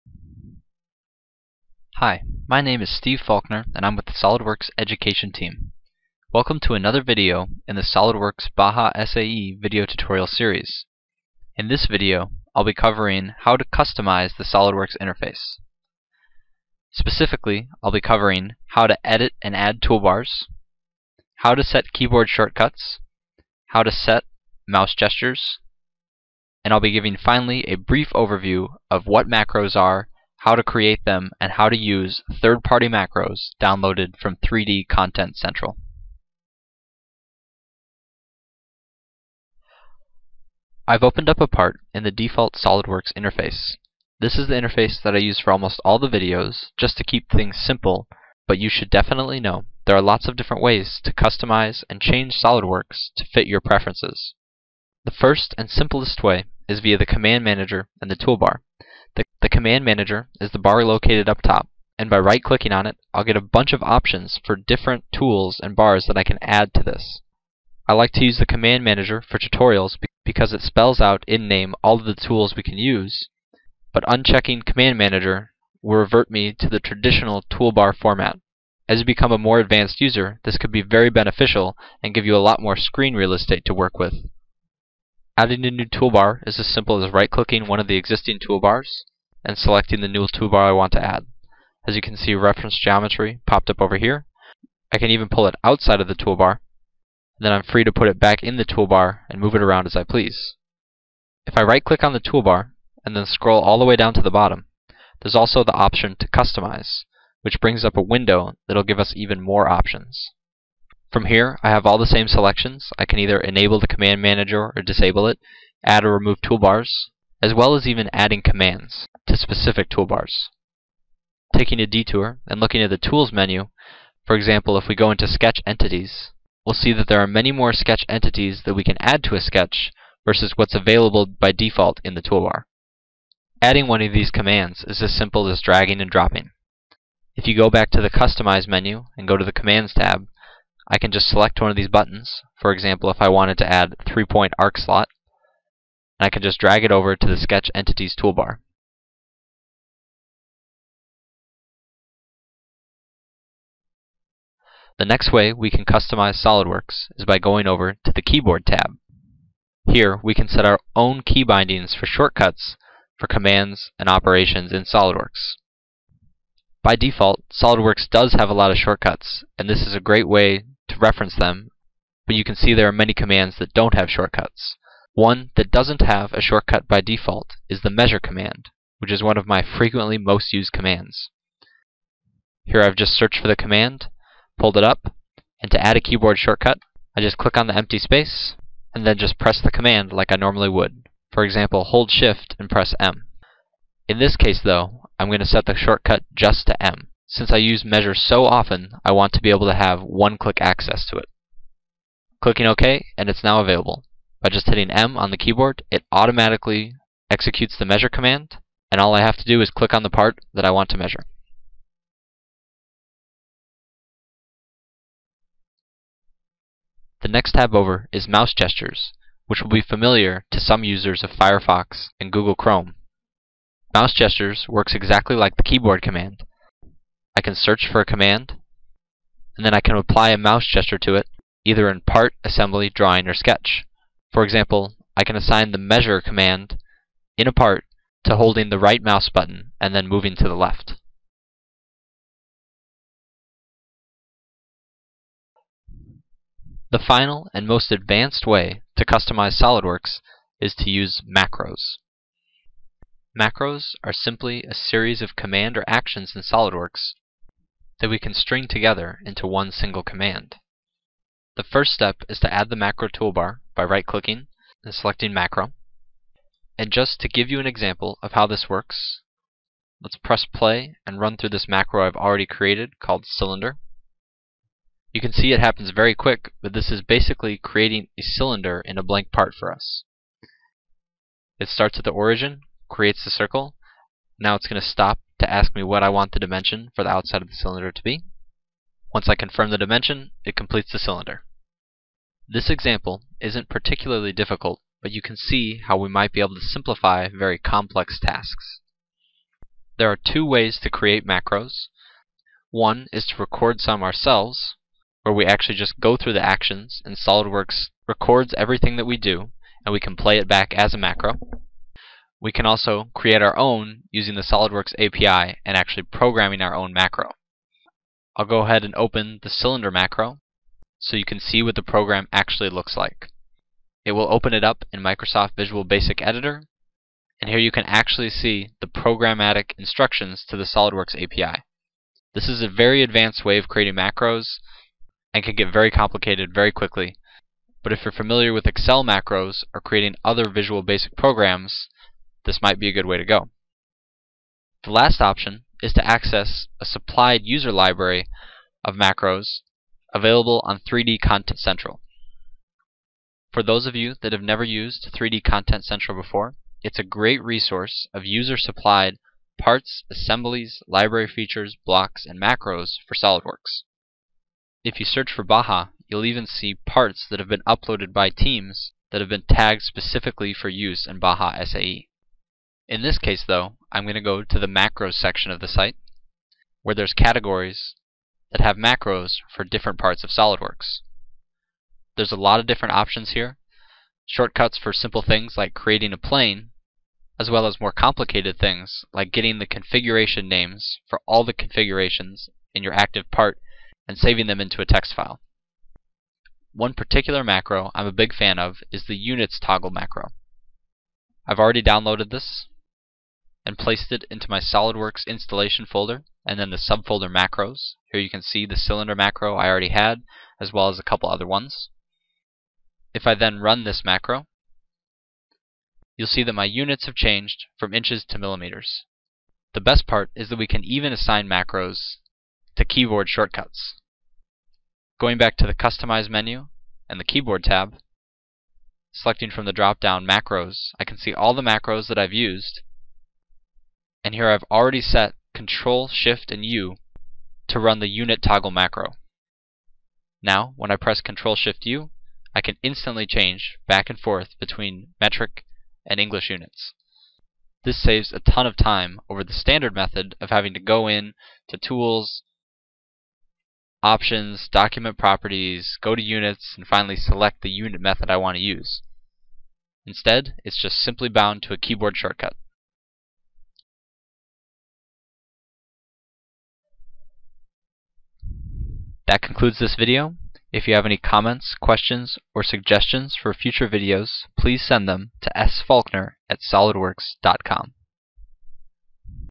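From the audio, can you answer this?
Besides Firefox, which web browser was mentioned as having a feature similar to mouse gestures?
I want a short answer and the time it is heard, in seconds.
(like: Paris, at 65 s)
Google Chrome, at 222 s.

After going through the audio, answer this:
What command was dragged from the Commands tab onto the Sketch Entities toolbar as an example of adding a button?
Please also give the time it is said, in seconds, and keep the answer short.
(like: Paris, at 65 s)
3-point arc slot, at 144 s.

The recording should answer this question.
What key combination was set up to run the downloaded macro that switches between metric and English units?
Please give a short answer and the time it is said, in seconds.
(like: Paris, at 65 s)
Control Shift U, at 435 s.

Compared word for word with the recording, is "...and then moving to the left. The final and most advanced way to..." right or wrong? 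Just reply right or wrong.
right.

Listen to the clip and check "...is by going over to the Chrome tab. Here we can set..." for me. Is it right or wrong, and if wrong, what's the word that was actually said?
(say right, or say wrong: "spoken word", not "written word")
wrong: "Keyboard", not "Chrome".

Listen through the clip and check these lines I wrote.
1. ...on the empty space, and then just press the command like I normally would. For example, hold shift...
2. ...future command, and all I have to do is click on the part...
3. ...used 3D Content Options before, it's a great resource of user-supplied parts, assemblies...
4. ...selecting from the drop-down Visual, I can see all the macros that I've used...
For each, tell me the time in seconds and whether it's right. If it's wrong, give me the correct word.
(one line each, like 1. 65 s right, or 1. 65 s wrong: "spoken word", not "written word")
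1. 187 s right
2. 207 s wrong: "measure", not "future"
3. 354 s wrong: "Central", not "Options"
4. 429 s wrong: "Macros", not "Visual".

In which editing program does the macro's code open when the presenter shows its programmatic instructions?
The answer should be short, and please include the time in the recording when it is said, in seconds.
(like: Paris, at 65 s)
Microsoft Visual Basic Editor, at 325 s.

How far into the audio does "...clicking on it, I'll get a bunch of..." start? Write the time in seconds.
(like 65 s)
62 s.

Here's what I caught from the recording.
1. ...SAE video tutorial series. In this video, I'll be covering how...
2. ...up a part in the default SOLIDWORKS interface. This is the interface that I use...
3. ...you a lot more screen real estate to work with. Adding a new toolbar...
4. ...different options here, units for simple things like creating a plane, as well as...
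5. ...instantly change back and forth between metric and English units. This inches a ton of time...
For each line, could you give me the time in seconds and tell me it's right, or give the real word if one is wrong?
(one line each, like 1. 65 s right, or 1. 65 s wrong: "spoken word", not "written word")
1. 9 s right
2. 41 s right
3. 82 s right
4. 382 s wrong: "shortcuts", not "units"
5. 442 s wrong: "saves", not "inches".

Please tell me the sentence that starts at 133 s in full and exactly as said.
Adding one of these commands is as simple as dragging and dropping.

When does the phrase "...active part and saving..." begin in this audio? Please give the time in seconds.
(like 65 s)
392 s.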